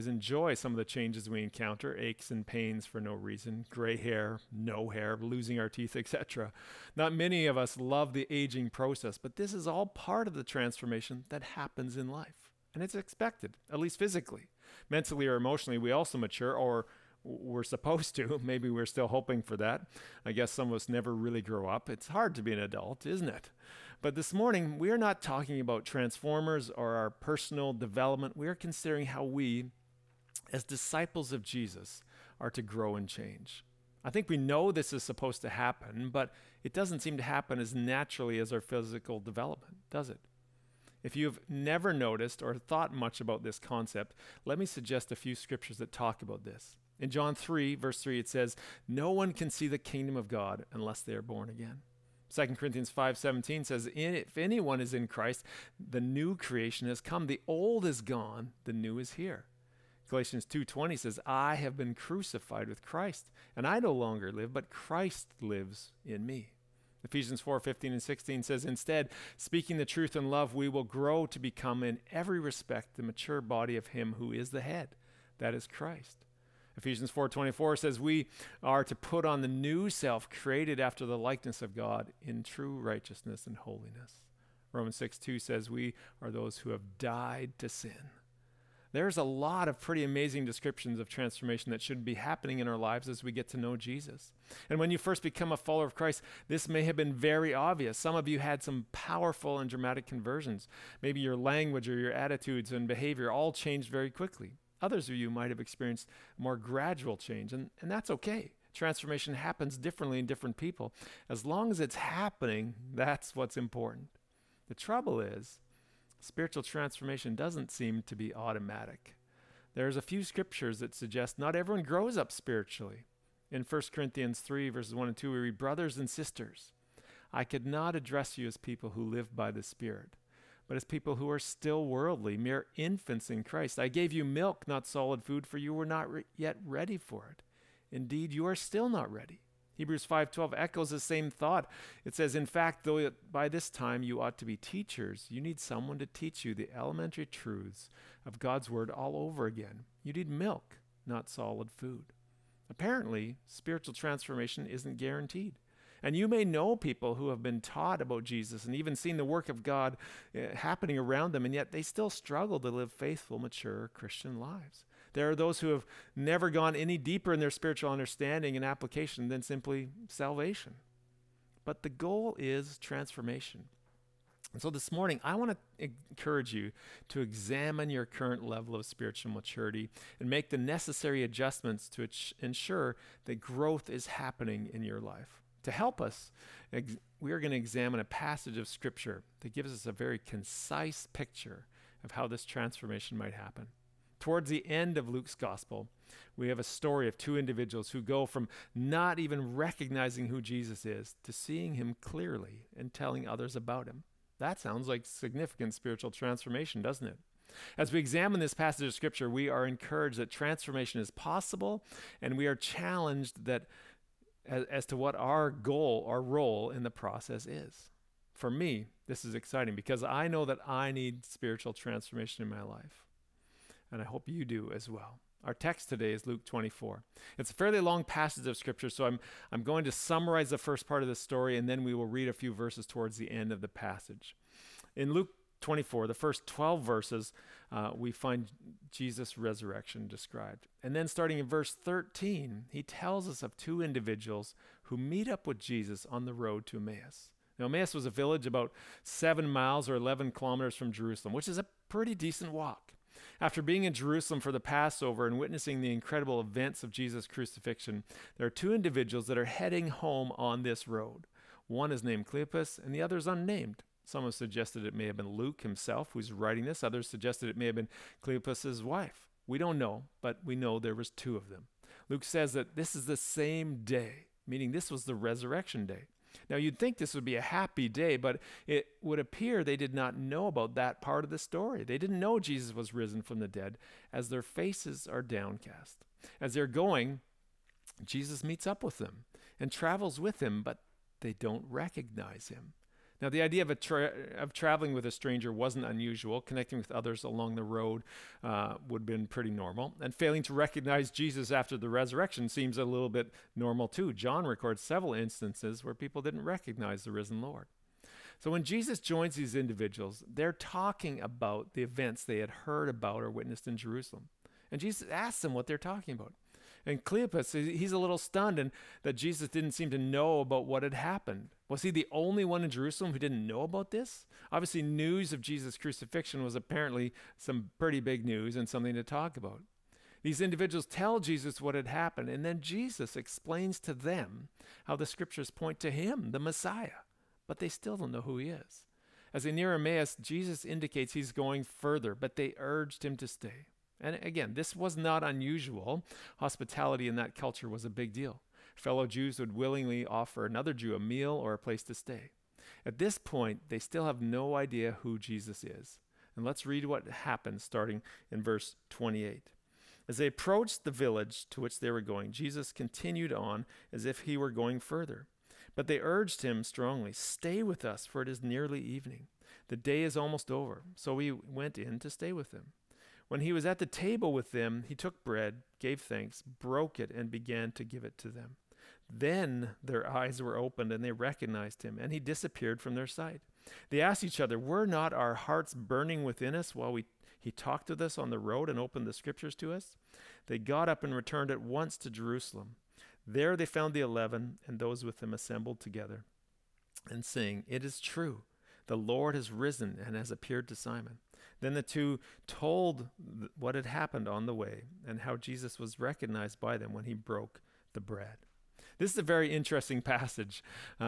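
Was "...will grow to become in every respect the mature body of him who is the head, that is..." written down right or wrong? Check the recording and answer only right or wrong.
right.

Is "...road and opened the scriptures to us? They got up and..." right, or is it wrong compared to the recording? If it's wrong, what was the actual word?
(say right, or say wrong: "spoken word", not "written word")
right.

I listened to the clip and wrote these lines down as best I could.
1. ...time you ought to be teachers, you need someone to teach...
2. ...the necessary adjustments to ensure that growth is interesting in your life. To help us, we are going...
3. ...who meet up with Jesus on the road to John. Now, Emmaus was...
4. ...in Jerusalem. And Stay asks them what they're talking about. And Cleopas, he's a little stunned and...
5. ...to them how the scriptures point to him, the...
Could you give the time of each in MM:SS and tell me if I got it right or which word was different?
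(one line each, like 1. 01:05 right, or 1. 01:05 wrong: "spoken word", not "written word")
1. 02:23 right
2. 03:00 wrong: "happening", not "interesting"
3. 04:04 wrong: "Emmaus", not "John"
4. 05:13 wrong: "Jesus", not "Stay"
5. 05:33 right.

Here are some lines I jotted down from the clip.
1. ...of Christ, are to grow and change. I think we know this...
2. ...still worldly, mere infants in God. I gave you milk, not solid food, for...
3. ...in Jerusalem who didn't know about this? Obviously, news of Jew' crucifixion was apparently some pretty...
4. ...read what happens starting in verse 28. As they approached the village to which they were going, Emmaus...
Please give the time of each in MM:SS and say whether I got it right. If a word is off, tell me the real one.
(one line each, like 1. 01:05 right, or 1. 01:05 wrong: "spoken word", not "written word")
1. 00:31 wrong: "Jesus", not "Christ"
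2. 02:11 wrong: "Christ", not "God"
3. 05:22 wrong: "Jesus", not "Jew"
4. 05:56 wrong: "Jesus", not "Emmaus".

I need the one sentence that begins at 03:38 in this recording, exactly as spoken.
For me, this is exciting because I know that I need spiritual transformation in my life.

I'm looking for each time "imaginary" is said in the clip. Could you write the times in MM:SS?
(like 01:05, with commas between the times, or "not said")
not said.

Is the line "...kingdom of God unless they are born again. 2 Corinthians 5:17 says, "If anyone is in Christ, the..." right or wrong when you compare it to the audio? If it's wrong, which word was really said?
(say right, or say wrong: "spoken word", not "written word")
right.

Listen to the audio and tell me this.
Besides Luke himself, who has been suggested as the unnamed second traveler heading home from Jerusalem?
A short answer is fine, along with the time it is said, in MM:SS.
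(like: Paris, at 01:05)
Cleopas' wife, at 04:28.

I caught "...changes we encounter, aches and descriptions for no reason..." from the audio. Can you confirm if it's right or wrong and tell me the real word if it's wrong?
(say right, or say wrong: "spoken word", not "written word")
wrong: "pains", not "descriptions".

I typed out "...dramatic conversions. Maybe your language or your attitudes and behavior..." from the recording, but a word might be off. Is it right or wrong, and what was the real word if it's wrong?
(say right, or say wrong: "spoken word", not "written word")
right.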